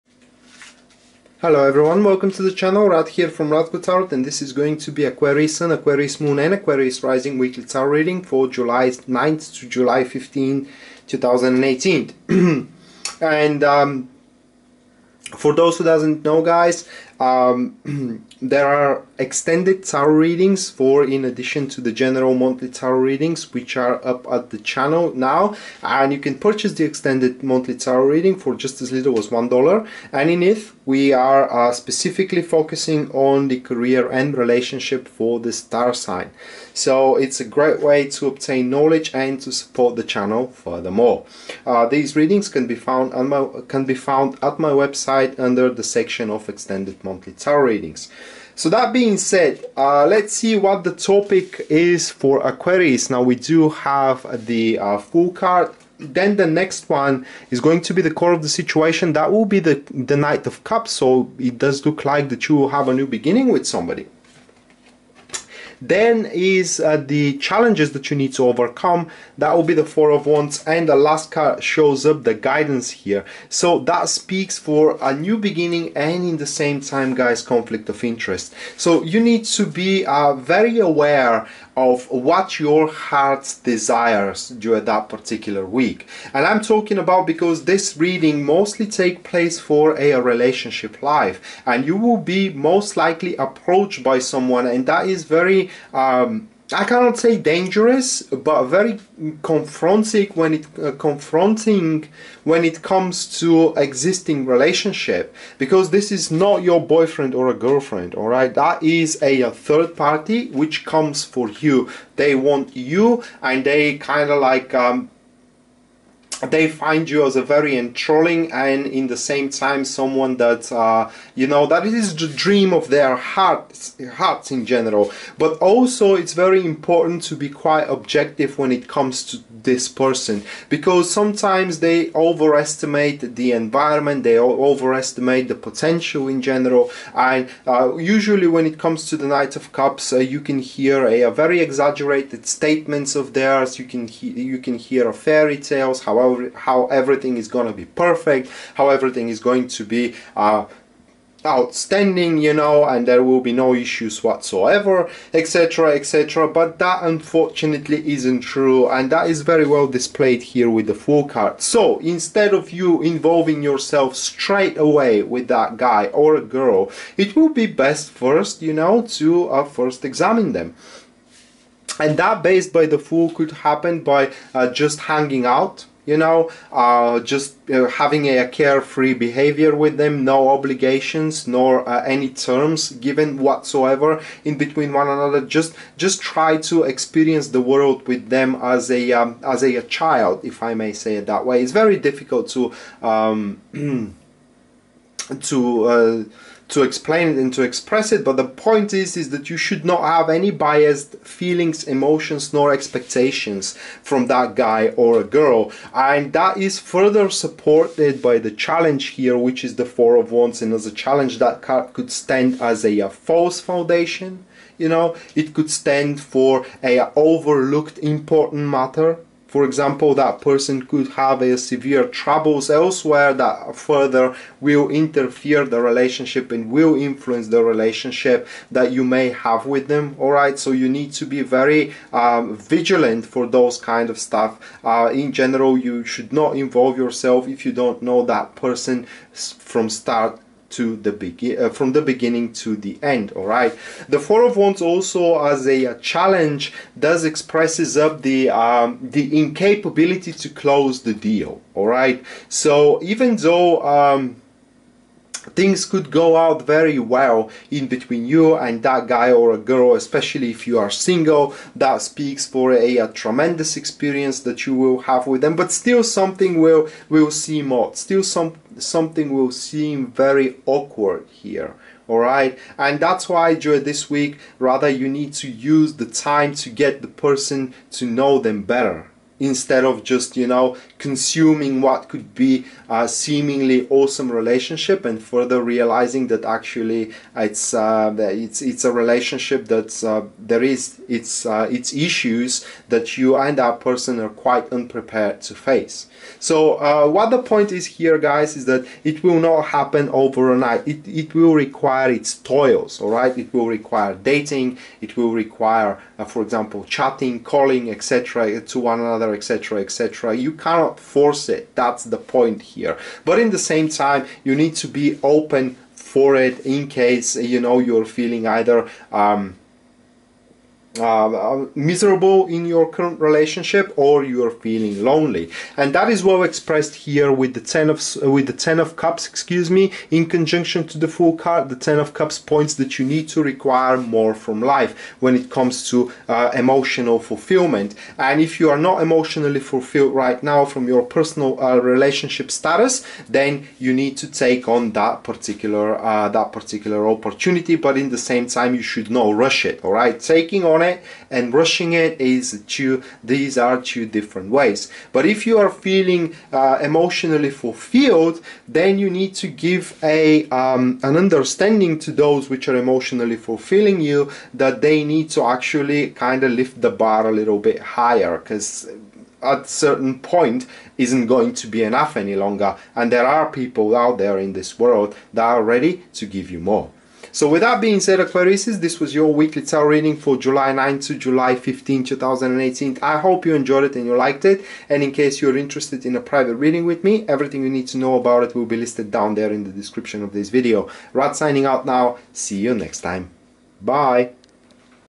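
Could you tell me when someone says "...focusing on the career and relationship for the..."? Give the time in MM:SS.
00:32.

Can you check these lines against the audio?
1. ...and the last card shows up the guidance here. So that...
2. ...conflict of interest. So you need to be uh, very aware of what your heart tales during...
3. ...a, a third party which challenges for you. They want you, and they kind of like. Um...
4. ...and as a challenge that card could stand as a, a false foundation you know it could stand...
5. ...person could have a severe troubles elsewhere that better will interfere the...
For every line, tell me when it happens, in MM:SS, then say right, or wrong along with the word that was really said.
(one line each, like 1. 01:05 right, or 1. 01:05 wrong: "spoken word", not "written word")
1. 01:10 right
2. 01:17 wrong: "desires", not "tales"
3. 01:49 wrong: "comes", not "challenges"
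4. 03:30 right
5. 03:40 wrong: "further", not "better".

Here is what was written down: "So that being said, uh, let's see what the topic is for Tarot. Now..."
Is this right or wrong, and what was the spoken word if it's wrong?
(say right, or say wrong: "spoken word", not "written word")
wrong: "Aquarius", not "Tarot".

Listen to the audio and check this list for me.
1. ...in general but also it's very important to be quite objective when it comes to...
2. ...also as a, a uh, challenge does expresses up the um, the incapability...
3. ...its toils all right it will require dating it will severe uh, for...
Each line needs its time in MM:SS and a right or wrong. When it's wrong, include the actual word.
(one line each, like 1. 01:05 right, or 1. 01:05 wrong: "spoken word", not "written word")
1. 02:04 right
2. 04:04 right
3. 05:02 wrong: "require", not "severe".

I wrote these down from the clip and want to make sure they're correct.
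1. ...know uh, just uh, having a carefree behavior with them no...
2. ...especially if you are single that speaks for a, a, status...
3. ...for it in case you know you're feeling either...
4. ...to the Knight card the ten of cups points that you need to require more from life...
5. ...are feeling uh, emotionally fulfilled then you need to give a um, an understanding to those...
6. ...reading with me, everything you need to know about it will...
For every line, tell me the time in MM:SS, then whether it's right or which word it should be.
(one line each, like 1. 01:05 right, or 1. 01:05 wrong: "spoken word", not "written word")
1. 02:56 right
2. 04:19 wrong: "tremendous", not "status"
3. 05:15 right
4. 05:30 wrong: "Fool", not "Knight"
5. 05:55 right
6. 06:26 right.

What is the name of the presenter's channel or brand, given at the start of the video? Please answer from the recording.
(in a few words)
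Rad Tarot.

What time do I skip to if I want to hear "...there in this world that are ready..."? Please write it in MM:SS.
06:14.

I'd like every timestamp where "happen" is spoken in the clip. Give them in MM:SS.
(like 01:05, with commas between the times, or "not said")
02:53, 04:59.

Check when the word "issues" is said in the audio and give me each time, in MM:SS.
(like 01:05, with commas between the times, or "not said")
02:33, 04:52.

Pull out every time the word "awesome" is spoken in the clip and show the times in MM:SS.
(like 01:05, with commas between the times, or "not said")
04:43.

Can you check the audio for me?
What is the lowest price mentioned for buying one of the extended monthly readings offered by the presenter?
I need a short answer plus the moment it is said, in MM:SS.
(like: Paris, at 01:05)
$1, at 00:29.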